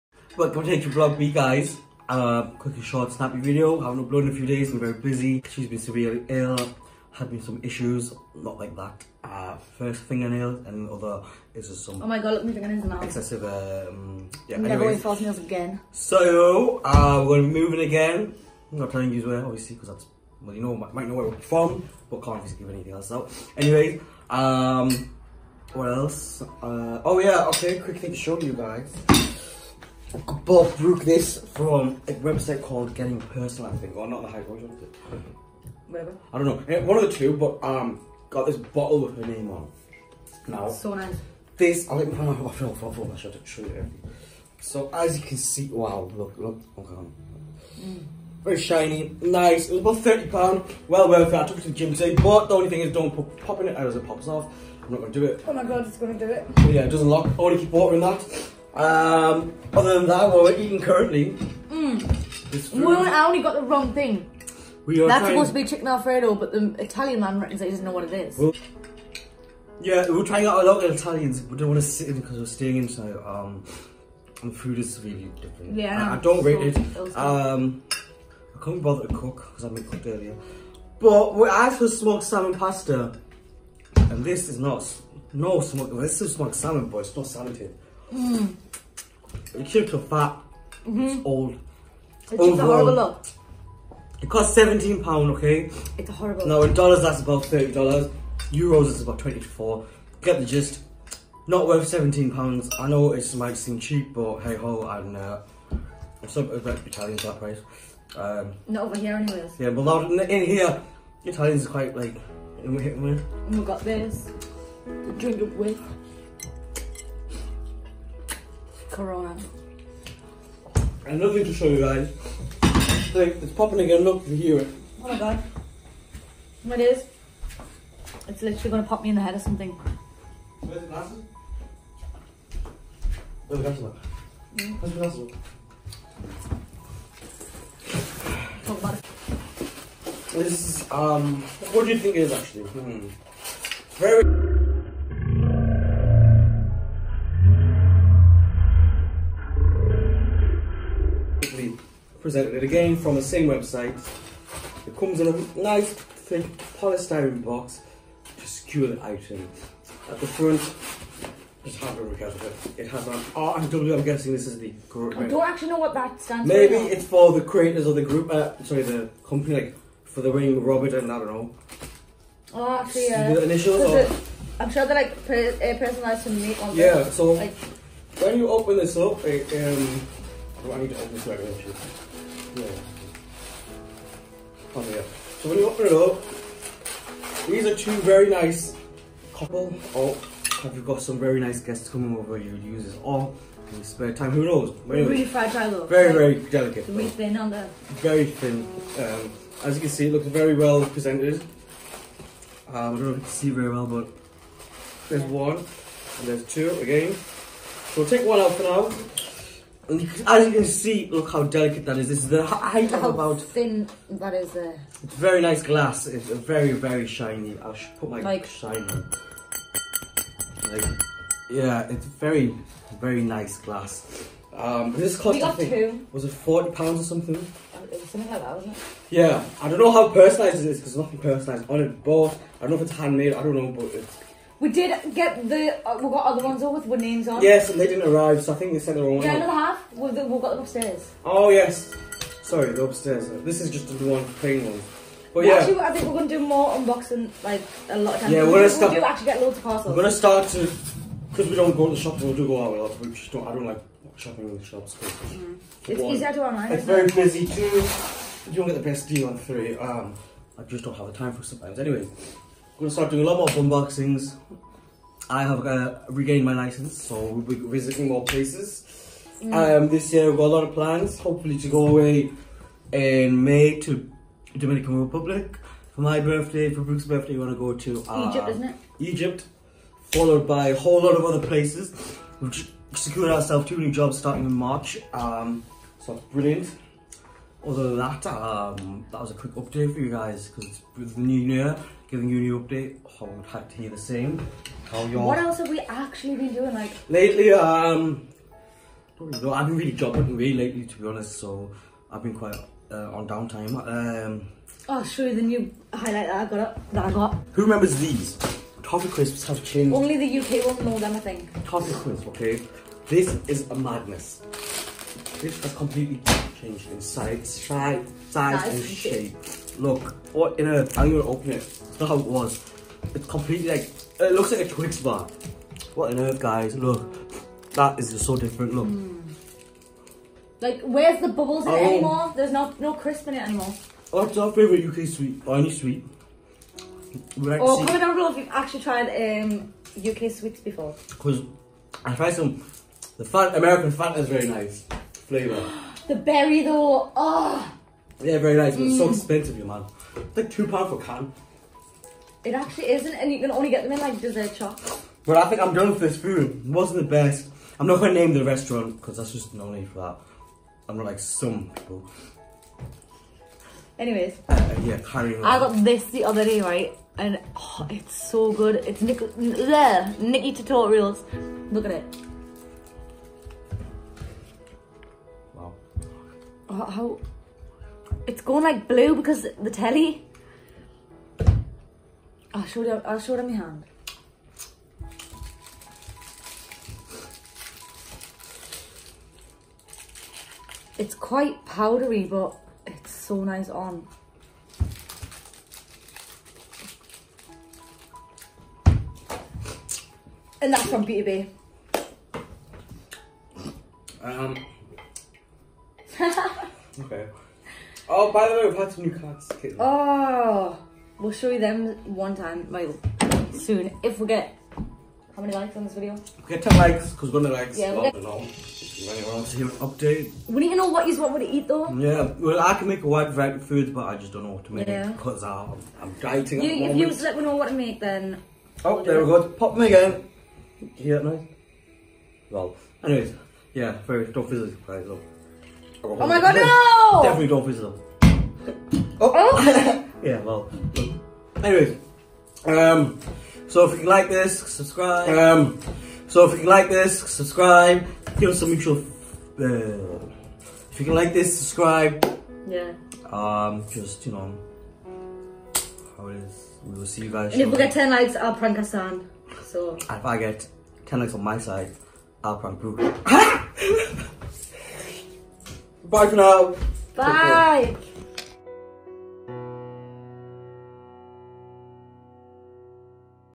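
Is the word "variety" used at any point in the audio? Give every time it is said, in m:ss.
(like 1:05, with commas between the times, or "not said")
7:03.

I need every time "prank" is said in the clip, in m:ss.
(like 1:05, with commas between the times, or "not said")
7:38, 7:42.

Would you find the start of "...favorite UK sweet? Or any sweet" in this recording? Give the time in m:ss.
5:34.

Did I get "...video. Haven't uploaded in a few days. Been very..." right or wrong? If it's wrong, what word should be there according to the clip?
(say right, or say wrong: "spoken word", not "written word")
right.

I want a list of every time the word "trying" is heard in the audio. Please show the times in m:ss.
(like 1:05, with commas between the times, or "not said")
1:05, 1:10.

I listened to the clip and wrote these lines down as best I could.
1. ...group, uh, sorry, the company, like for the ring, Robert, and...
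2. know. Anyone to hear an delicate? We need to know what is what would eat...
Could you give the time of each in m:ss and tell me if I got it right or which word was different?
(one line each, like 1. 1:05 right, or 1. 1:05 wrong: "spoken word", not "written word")
1. 2:48 right
2. 6:58 wrong: "update", not "delicate".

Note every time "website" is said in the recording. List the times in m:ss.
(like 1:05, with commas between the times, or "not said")
0:32, 2:33.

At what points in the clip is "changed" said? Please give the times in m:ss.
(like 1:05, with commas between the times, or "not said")
5:09, 5:16.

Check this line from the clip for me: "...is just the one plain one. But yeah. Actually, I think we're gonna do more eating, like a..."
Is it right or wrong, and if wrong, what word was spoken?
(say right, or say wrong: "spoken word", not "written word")
wrong: "unboxing", not "eating".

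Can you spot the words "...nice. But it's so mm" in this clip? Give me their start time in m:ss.
5:48.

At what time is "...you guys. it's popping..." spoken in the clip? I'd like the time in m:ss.
2:01.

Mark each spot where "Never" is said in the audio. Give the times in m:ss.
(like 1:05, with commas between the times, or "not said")
0:14.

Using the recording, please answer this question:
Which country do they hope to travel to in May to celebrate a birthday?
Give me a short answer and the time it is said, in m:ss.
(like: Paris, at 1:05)
Dominican Republic, at 4:34.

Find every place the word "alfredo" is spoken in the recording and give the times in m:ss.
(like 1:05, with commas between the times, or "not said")
1:05.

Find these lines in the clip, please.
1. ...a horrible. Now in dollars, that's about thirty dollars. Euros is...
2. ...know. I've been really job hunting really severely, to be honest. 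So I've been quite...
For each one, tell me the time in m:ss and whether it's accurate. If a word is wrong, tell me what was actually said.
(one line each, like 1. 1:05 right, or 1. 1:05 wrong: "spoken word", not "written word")
1. 1:36 right
2. 4:59 wrong: "lately", not "severely".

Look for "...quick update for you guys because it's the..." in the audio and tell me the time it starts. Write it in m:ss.
4:49.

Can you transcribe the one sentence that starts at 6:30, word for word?
It's quite powdery, but it's so nice on.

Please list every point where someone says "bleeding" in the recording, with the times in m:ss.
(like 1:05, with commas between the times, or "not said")
not said.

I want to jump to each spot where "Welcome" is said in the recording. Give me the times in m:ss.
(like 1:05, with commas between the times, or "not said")
0:00.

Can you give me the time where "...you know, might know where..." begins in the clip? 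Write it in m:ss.
0:20.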